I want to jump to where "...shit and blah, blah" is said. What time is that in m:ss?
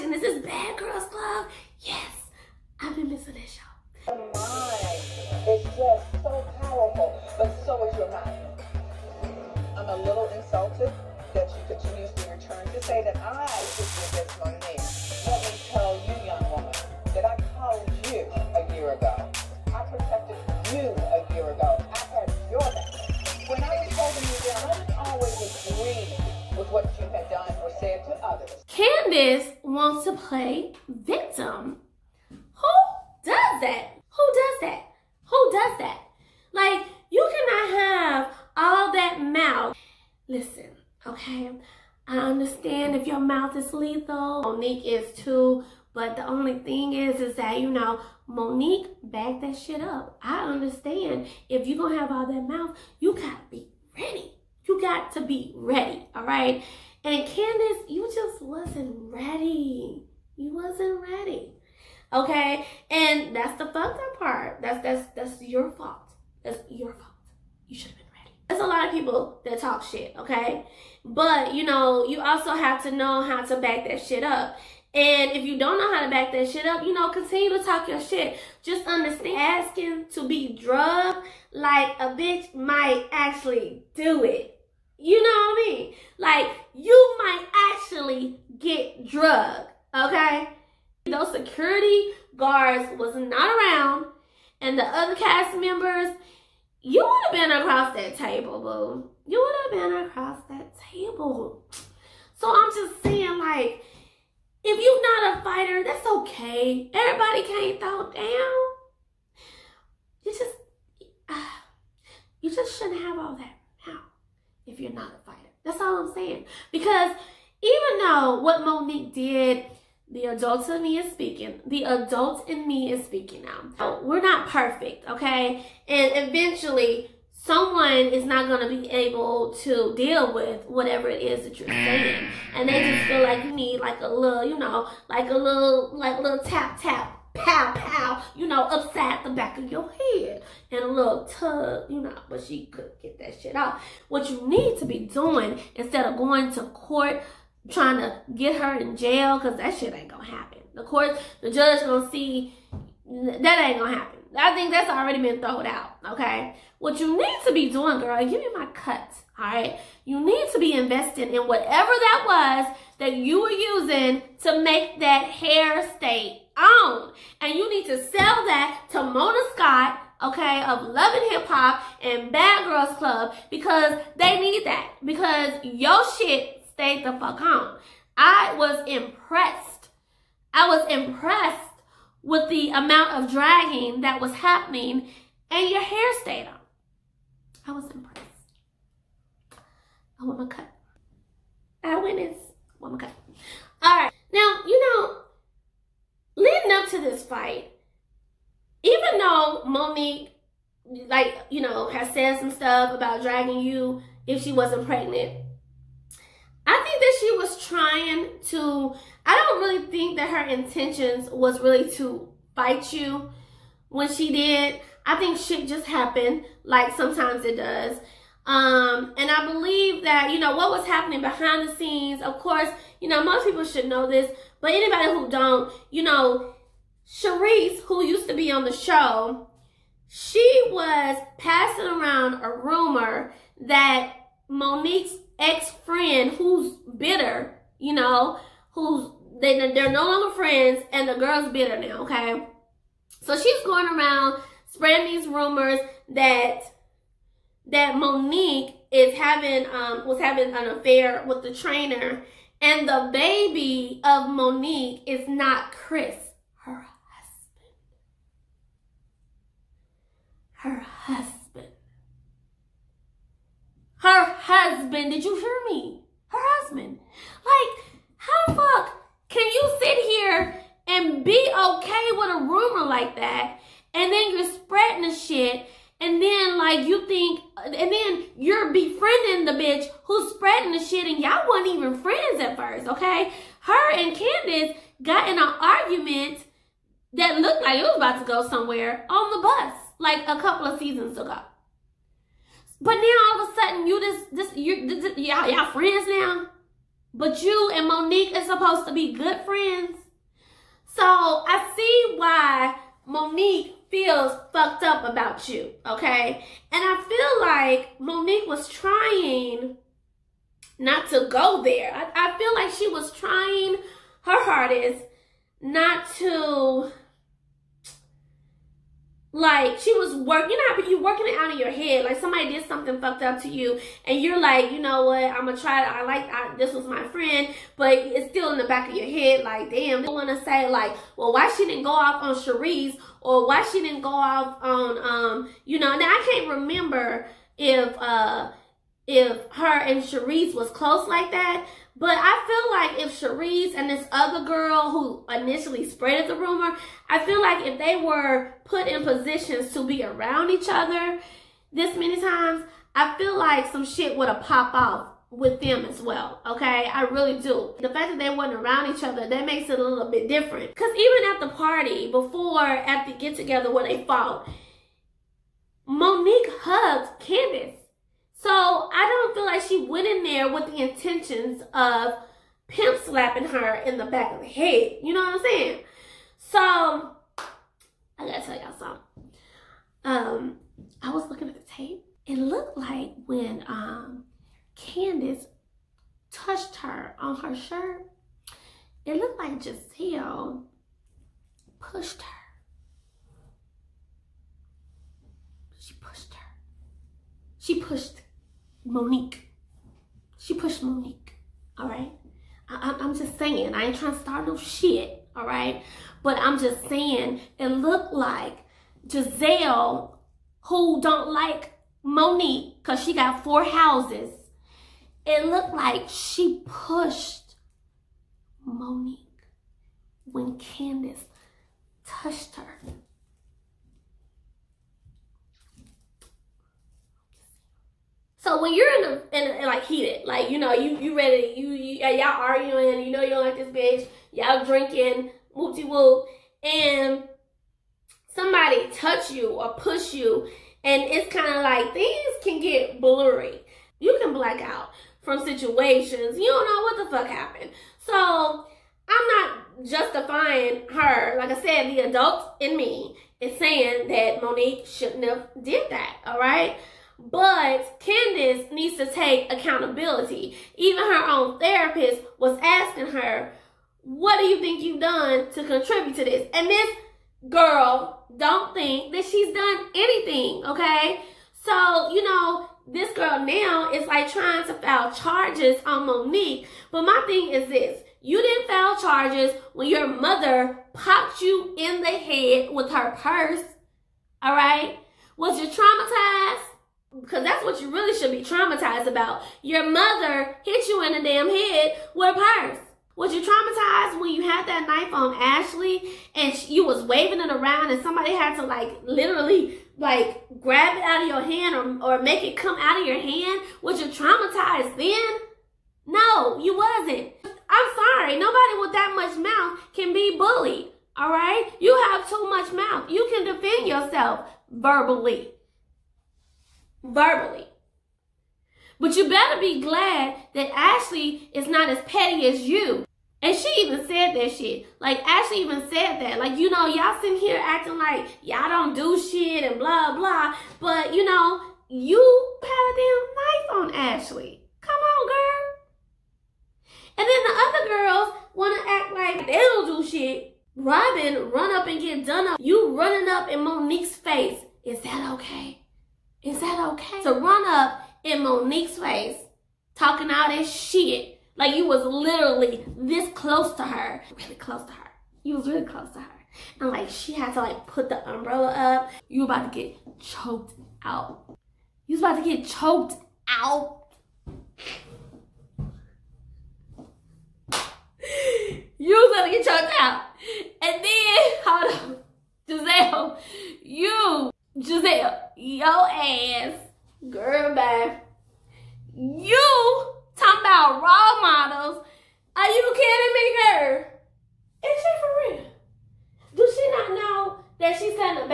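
8:49.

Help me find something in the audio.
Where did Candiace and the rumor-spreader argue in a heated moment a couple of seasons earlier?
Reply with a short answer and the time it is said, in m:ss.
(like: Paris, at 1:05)
On the bus, at 4:49.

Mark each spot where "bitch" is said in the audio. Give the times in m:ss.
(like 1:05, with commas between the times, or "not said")
1:22, 4:39, 7:13.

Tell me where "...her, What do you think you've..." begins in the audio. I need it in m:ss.
7:43.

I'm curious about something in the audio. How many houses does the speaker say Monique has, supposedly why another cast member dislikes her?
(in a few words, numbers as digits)
4.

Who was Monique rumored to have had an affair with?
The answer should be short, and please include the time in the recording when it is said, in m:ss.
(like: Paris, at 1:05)
The trainer, at 4:11.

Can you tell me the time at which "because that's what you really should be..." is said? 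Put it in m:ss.
8:07.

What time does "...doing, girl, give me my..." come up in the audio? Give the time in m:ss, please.
2:37.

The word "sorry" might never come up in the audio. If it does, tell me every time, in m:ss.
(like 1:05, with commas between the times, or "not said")
8:27.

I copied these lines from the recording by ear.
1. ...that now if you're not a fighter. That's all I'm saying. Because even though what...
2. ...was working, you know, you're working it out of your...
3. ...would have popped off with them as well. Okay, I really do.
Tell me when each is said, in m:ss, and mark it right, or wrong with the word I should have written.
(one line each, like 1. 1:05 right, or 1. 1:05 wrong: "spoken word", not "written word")
1. 1:53 right
2. 5:19 right
3. 5:54 right.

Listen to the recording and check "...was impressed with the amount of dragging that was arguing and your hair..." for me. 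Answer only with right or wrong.
wrong.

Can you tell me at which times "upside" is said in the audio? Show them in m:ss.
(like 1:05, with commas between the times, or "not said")
2:18.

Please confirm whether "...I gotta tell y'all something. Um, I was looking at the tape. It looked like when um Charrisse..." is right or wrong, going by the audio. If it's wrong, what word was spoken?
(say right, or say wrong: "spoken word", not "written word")
wrong: "Candiace", not "Charrisse".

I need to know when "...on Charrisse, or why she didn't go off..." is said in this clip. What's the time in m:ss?
5:32.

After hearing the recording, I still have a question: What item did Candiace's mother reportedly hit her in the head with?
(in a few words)
Her purse.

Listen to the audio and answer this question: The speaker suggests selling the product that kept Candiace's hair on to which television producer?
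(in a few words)
Mona Scott.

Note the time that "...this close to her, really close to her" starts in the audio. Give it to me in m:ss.
9:12.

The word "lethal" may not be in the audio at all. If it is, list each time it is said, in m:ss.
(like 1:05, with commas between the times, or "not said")
0:43.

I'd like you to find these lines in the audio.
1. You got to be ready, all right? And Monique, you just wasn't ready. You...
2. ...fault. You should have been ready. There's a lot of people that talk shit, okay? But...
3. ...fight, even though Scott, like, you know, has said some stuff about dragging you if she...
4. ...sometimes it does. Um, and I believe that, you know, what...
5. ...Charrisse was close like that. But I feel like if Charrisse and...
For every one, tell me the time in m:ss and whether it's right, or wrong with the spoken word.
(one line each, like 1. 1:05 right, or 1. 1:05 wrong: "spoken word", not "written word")
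1. 0:54 wrong: "Candiace", not "Monique"
2. 1:06 right
3. 3:17 wrong: "Monique", not "Scott"
4. 3:36 right
5. 5:40 right.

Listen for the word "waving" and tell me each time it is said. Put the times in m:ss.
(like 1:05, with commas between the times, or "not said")
8:17.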